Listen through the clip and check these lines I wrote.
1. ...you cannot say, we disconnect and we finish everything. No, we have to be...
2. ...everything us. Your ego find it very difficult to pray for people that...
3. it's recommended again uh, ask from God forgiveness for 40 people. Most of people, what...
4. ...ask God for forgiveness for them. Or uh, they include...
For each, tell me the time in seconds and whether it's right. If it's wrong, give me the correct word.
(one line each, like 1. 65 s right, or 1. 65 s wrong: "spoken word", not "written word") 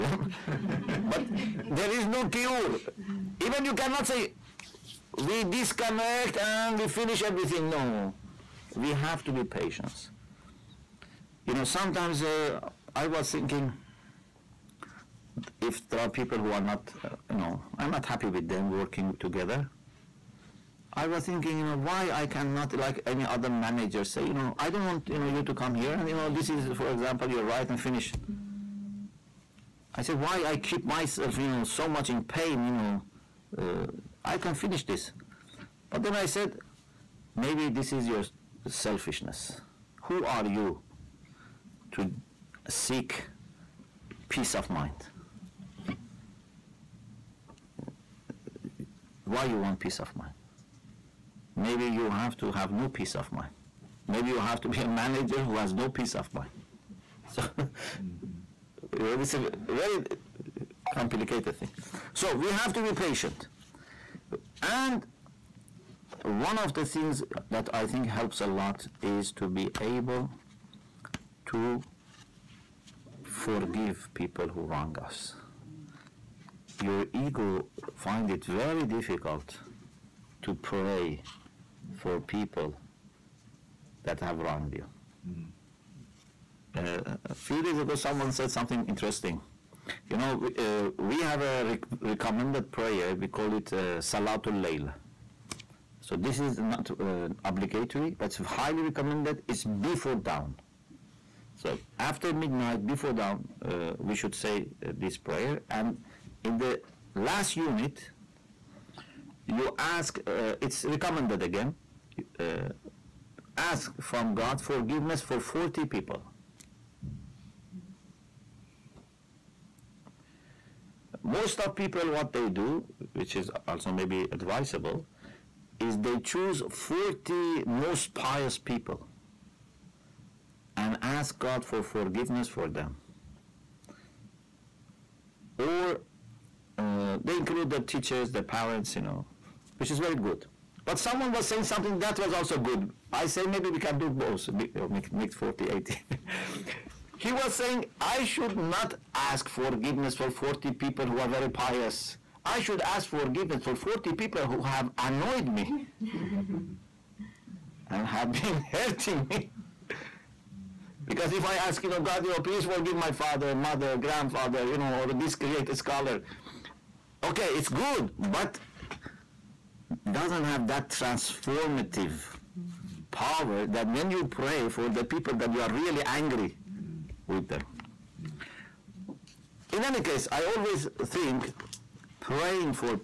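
1. 3 s right
2. 74 s wrong: "wrong", not "everything"
3. 110 s right
4. 131 s right.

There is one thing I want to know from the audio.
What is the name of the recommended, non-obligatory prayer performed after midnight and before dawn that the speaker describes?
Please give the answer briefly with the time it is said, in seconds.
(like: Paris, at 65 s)
Salatul Layl, at 94 s.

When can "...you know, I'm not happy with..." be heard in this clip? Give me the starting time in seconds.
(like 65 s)
17 s.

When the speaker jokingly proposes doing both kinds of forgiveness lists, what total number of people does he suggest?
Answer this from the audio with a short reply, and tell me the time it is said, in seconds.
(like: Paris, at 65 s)
80, at 145 s.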